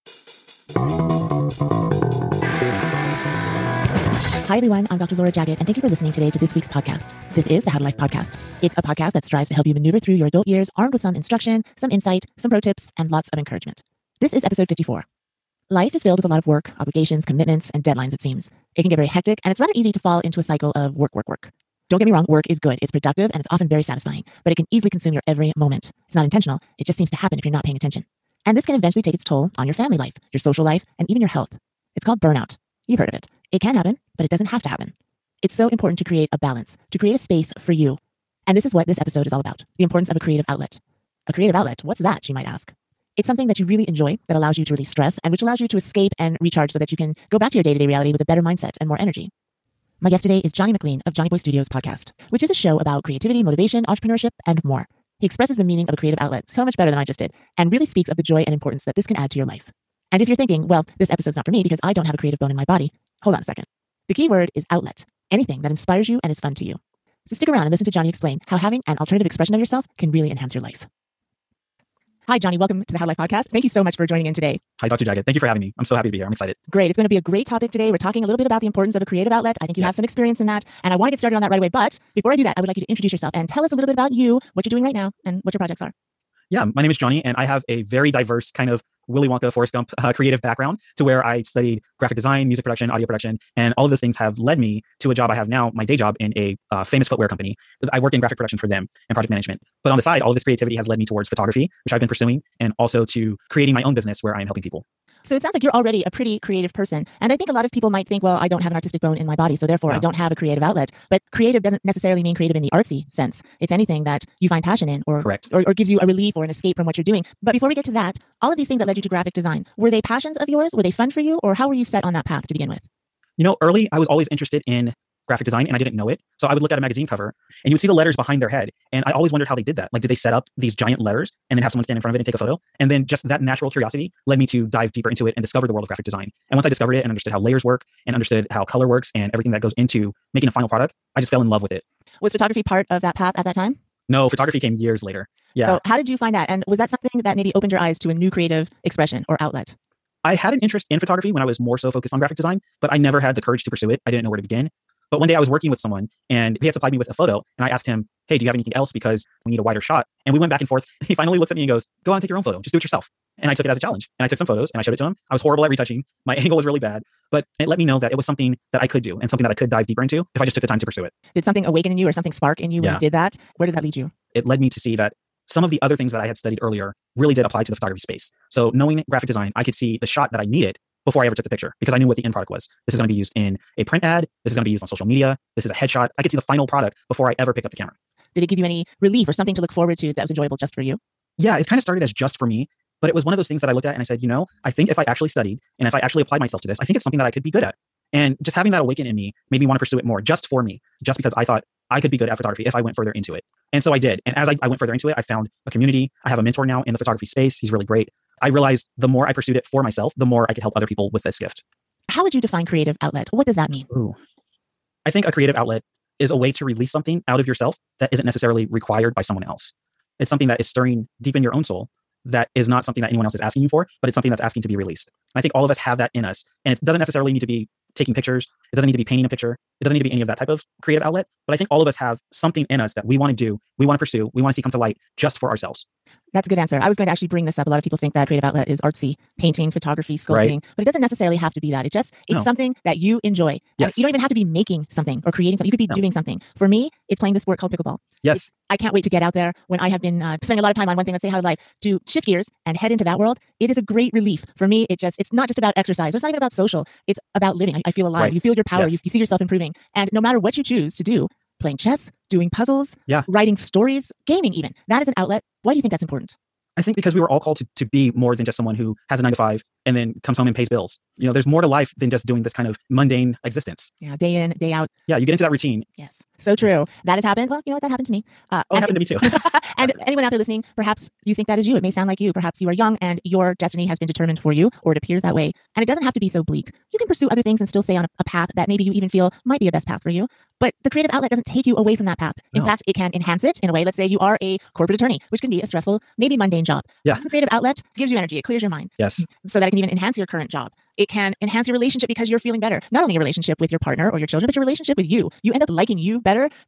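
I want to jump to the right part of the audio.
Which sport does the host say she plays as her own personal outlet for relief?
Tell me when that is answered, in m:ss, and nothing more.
4:07.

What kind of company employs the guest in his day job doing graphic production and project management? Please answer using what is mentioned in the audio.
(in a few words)
Footwear company.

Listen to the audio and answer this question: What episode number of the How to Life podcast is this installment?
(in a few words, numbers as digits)
54.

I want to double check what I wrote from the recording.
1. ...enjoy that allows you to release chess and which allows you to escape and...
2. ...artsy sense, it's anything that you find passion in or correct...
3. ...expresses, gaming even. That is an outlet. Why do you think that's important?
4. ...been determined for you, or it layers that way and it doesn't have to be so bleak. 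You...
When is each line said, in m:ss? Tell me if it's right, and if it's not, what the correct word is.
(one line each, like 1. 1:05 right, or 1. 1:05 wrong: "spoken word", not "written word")
1. 0:43 wrong: "stress", not "chess"
2. 1:52 right
3. 4:23 wrong: "stories", not "expresses"
4. 4:43 wrong: "appears", not "layers".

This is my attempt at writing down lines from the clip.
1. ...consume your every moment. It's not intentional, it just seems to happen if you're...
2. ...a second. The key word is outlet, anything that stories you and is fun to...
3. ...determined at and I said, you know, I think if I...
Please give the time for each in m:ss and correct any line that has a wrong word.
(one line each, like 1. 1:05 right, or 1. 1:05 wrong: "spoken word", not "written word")
1. 0:24 right
2. 1:03 wrong: "inspires", not "stories"
3. 3:13 wrong: "looked", not "determined".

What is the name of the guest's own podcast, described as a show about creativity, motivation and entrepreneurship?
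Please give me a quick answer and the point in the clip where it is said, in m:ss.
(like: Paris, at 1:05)
Johnny Boy Studios, at 0:51.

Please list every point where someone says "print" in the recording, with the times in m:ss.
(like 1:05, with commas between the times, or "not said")
3:03.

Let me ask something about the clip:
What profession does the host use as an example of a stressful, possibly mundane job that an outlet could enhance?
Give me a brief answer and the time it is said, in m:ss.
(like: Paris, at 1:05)
Corporate attorney, at 4:54.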